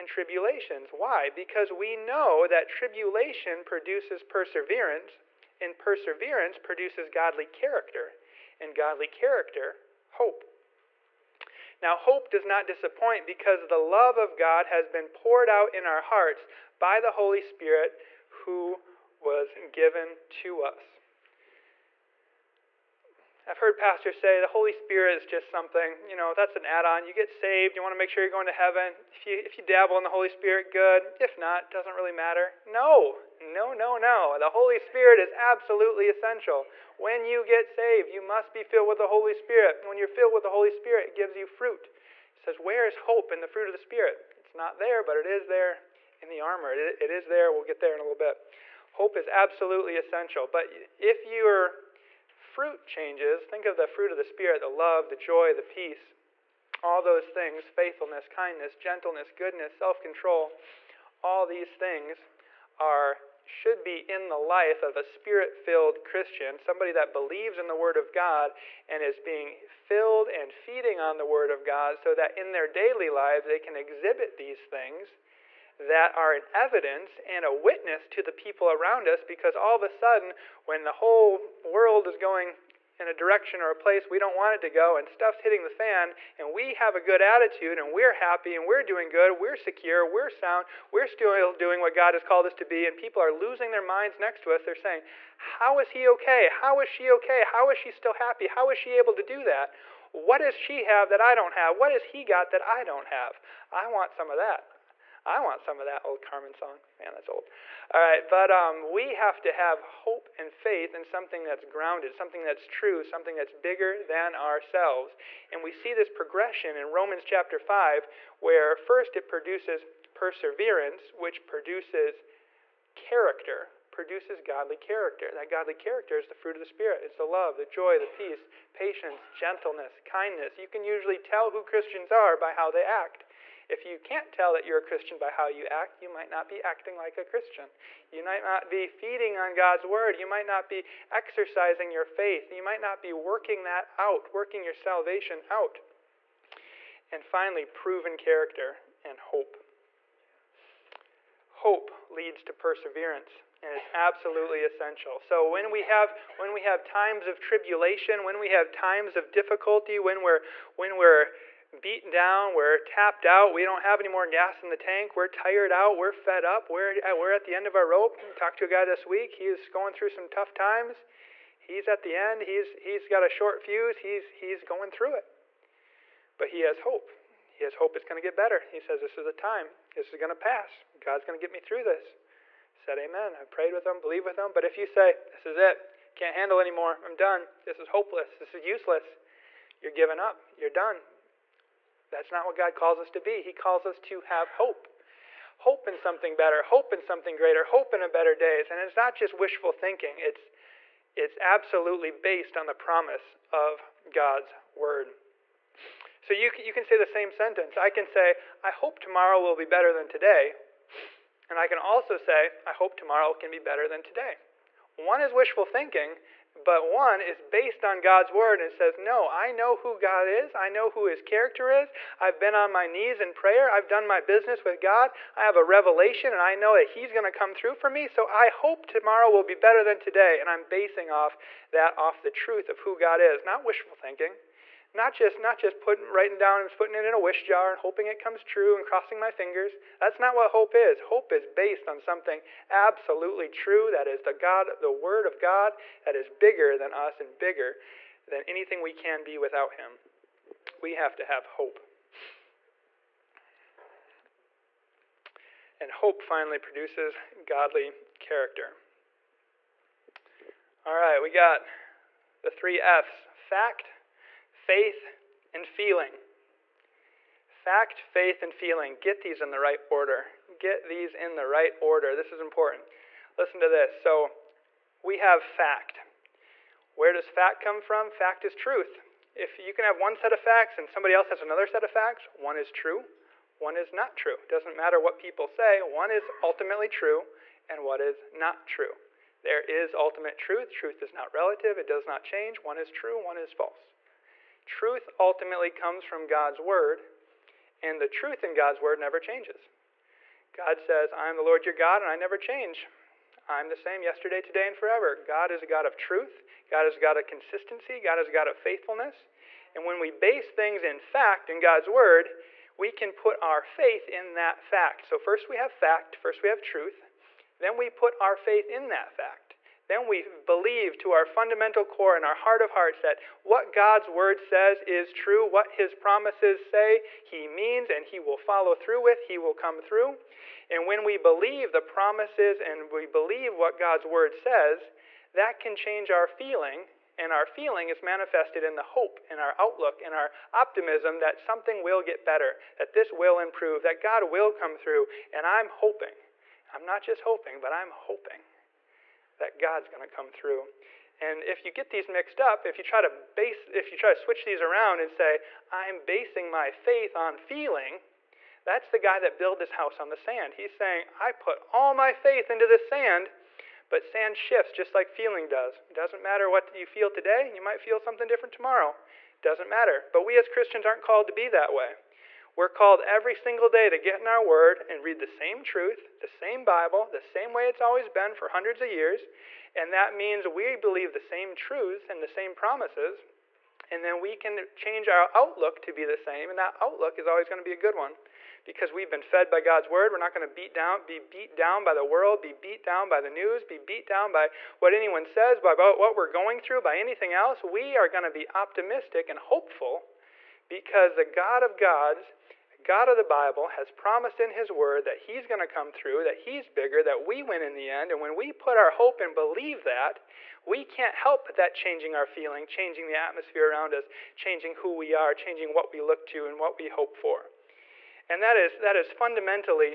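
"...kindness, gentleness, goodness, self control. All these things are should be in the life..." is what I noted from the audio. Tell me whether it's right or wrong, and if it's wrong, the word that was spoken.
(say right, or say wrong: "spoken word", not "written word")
right.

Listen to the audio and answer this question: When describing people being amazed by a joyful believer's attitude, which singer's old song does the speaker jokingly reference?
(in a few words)
Carmen.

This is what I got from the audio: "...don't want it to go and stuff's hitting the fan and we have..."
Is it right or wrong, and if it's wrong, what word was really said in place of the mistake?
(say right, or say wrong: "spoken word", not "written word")
right.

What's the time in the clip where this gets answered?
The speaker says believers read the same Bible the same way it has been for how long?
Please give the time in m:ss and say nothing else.
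6:18.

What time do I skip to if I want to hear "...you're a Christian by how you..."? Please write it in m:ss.
2:14.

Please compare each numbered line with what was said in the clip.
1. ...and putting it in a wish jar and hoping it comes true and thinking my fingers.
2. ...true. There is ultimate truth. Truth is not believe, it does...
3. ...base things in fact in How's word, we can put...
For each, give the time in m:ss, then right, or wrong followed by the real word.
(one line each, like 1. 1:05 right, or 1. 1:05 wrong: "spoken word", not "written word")
1. 3:56 wrong: "crossing", not "thinking"
2. 4:48 wrong: "relative", not "believe"
3. 5:10 wrong: "God", not "How".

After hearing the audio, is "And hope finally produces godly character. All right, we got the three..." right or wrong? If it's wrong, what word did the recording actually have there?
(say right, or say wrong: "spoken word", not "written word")
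right.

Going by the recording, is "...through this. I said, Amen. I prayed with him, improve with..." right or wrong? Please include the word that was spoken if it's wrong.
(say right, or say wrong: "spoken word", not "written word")
wrong: "believe", not "improve".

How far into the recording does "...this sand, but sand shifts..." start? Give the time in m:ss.
6:02.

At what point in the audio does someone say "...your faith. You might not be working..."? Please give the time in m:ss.
2:21.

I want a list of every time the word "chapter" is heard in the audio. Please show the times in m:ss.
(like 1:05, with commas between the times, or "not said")
1:57.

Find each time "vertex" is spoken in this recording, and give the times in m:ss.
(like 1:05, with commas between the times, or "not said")
not said.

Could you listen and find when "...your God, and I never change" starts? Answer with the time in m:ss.
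5:01.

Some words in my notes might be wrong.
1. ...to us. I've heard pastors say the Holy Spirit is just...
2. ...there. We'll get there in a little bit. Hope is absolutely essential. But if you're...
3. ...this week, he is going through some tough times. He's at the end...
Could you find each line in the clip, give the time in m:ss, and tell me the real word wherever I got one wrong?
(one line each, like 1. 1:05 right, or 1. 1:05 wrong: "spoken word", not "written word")
1. 0:20 right
2. 0:47 right
3. 2:48 right.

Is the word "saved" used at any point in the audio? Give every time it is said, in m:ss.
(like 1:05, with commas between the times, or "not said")
0:27, 0:37.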